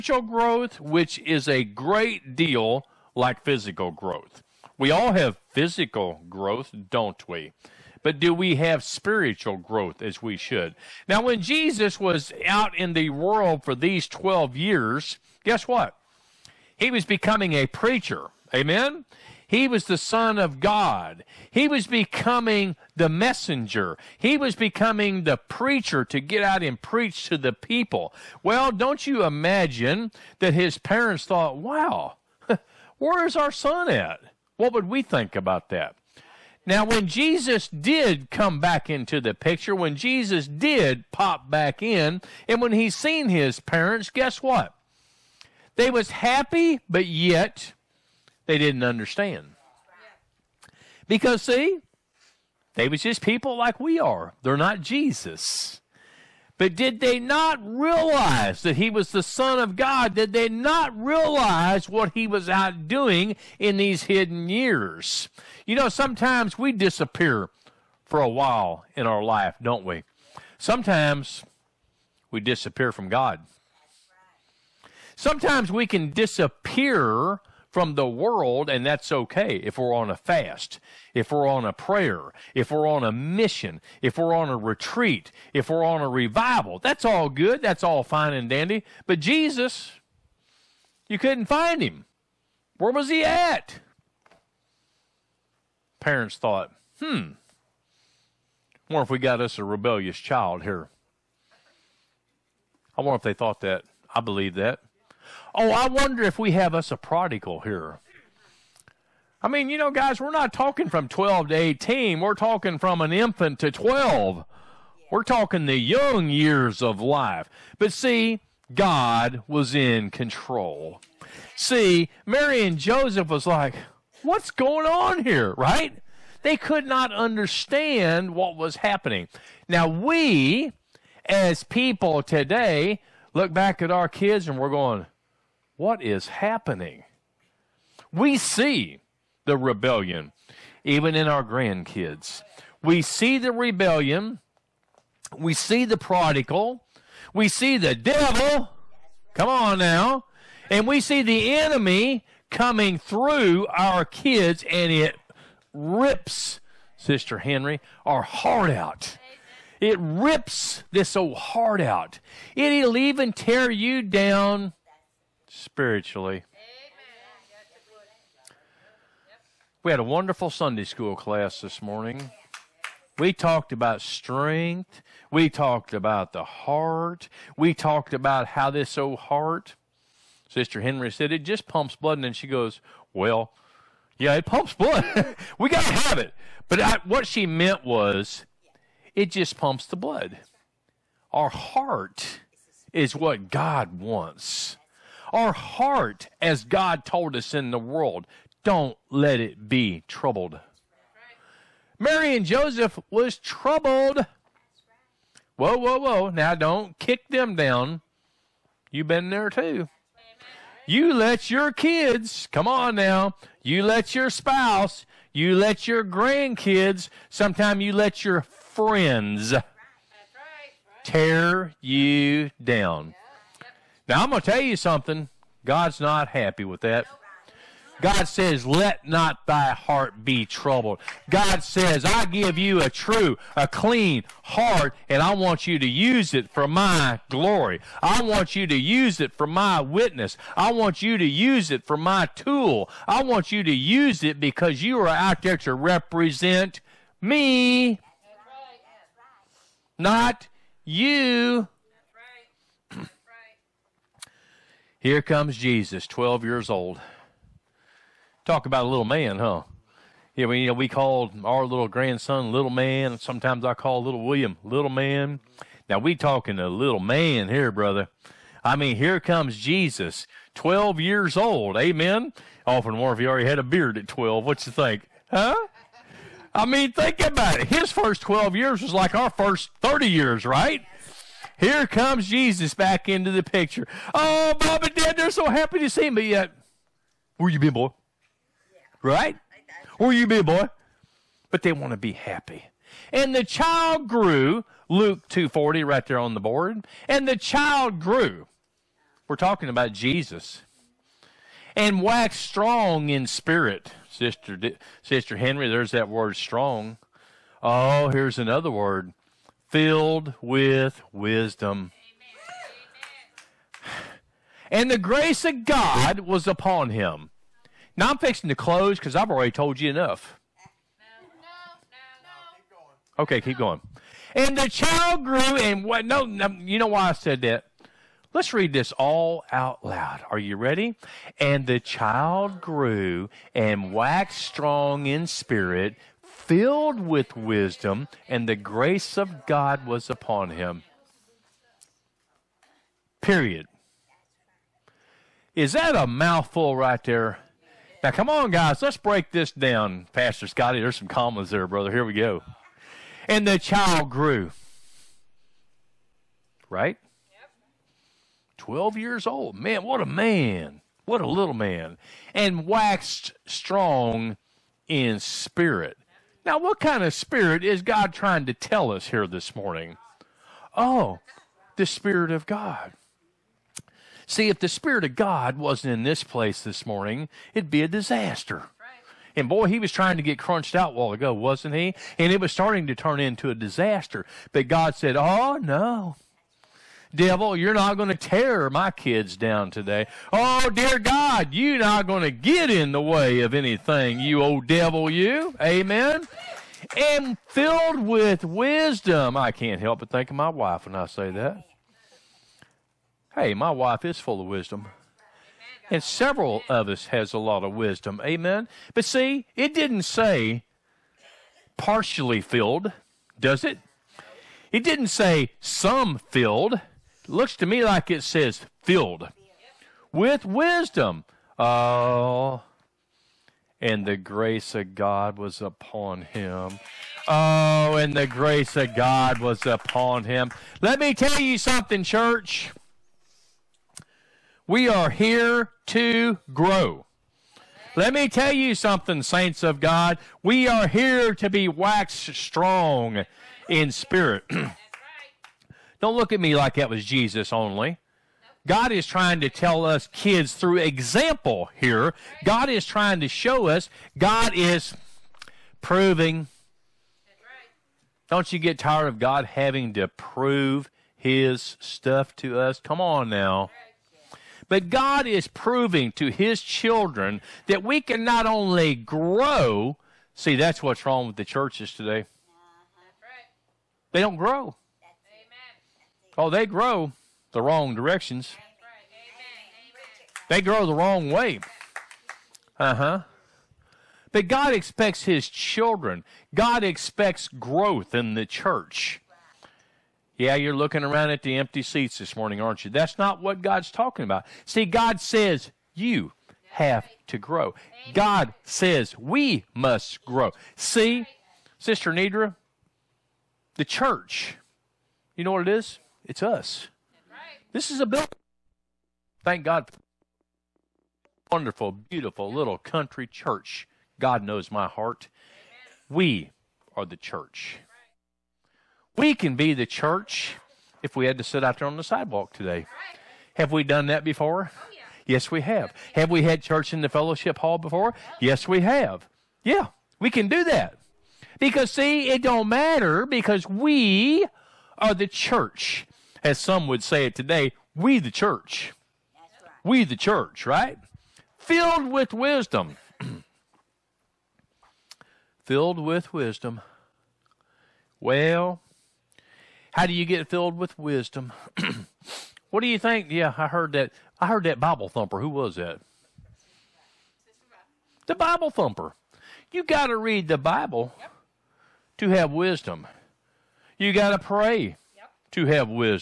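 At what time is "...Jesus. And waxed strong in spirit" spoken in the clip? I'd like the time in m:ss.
4:59.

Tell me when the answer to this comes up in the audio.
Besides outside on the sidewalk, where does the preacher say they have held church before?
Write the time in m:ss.
8:47.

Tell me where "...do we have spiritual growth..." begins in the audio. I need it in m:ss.
0:08.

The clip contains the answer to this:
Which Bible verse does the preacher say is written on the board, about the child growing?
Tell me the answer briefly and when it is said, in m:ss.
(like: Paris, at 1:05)
Luke 2:40, at 4:54.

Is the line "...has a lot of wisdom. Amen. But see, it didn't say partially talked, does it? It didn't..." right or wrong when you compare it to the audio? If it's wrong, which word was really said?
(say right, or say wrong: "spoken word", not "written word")
wrong: "filled", not "talked".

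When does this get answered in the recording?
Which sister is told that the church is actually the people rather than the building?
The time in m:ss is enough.
8:21.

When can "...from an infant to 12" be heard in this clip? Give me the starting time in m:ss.
1:52.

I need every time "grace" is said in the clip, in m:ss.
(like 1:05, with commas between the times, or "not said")
5:14, 5:38, 7:04, 7:08.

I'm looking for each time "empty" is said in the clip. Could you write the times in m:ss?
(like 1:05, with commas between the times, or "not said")
8:11.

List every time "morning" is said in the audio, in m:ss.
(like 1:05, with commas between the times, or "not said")
2:51, 6:09, 6:16, 8:12.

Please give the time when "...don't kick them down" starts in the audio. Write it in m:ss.
3:26.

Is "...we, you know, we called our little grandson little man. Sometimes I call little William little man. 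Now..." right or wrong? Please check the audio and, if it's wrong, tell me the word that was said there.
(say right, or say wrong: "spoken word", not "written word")
right.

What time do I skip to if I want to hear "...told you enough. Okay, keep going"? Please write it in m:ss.
5:19.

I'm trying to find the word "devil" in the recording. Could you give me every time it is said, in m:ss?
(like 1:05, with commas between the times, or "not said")
2:27, 6:27, 6:34.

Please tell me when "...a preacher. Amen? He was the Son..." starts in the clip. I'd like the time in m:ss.
0:17.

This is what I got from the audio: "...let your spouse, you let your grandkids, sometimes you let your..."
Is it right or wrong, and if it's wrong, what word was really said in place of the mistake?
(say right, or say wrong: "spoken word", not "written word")
right.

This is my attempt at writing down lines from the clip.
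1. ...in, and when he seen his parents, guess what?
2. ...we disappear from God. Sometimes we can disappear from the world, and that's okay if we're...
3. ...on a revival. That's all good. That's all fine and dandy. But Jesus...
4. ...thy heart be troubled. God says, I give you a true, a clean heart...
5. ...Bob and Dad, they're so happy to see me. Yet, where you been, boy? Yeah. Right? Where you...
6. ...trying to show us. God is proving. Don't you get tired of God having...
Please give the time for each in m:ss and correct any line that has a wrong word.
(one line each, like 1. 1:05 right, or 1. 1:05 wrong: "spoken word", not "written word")
1. 0:41 right
2. 1:12 right
3. 1:25 right
4. 3:49 right
5. 4:44 right
6. 7:32 right.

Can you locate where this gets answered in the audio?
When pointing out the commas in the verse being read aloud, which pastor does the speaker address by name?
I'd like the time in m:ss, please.
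5:50.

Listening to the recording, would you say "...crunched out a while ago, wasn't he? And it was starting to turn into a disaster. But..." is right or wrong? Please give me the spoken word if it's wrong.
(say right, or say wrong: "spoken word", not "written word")
right.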